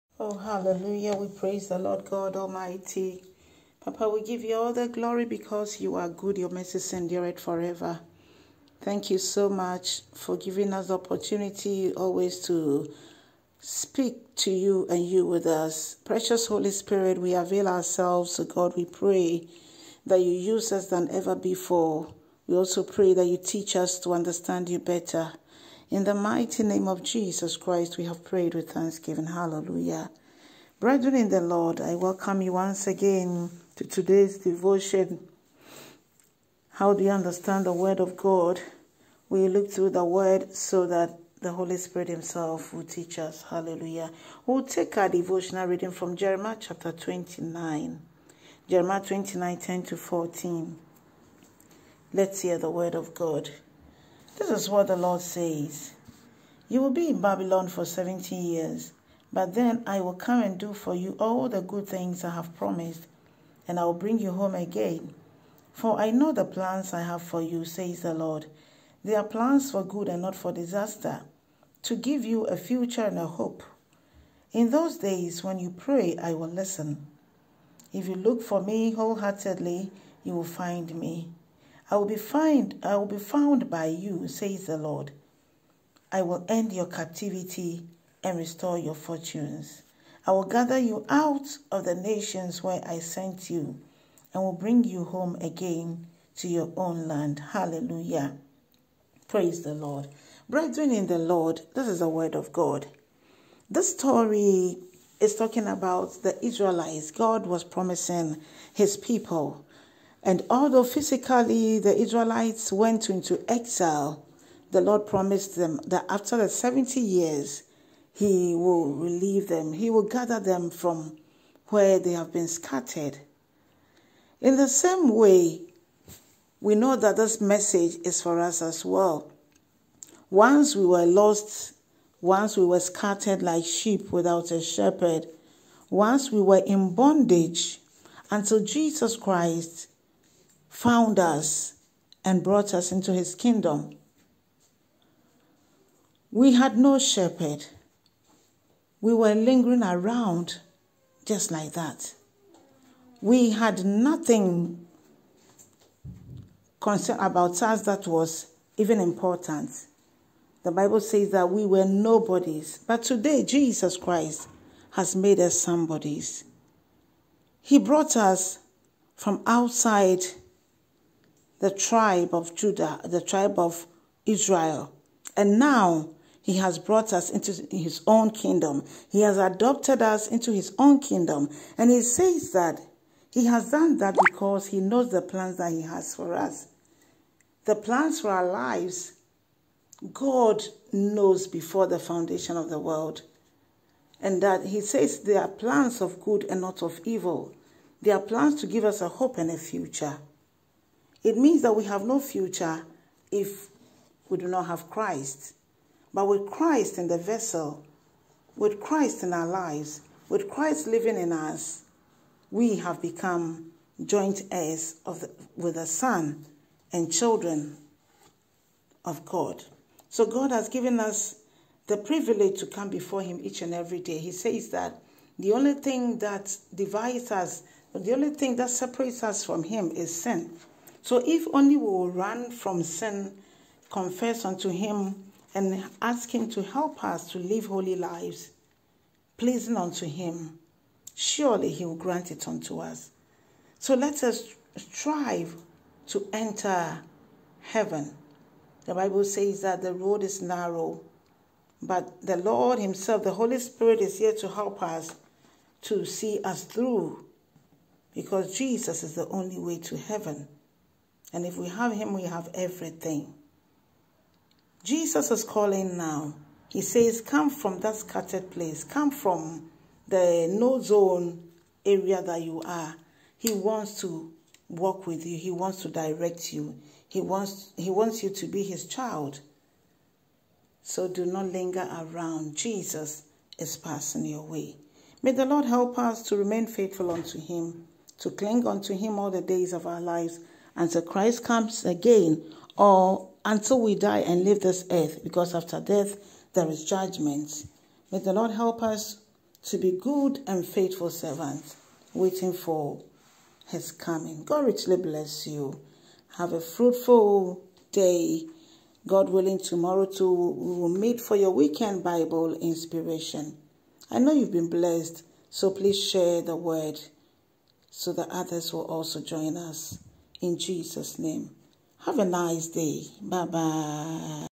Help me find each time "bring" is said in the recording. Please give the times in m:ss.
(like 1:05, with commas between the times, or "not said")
1:03, 1:34.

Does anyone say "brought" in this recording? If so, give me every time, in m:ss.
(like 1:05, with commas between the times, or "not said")
2:22, 2:47, 2:56.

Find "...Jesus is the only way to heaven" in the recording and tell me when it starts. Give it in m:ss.
4:18.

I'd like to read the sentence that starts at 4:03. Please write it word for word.
So let us strive to enter heaven.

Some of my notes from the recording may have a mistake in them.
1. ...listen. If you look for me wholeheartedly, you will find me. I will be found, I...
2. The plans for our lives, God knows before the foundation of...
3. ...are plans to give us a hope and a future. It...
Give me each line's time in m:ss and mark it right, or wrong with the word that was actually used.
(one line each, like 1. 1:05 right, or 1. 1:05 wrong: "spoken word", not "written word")
1. 1:16 right
2. 3:07 right
3. 3:18 right.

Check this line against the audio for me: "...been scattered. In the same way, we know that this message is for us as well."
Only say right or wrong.
right.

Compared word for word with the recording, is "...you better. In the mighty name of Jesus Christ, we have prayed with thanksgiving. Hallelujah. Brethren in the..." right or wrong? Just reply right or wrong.
right.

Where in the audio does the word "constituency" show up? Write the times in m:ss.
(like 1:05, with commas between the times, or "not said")
not said.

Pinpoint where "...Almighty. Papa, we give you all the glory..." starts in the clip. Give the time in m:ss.
0:02.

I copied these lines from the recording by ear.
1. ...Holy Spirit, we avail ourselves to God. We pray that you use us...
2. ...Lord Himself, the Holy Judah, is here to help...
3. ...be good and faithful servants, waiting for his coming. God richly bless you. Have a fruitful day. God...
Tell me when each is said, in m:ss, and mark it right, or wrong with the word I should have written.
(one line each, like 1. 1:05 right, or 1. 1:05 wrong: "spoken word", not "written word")
1. 0:16 right
2. 4:12 wrong: "Spirit", not "Judah"
3. 4:59 right.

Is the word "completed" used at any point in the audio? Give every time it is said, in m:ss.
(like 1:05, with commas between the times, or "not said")
not said.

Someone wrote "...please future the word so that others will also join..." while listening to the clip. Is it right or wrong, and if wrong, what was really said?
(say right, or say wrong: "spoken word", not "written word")
wrong: "share", not "future".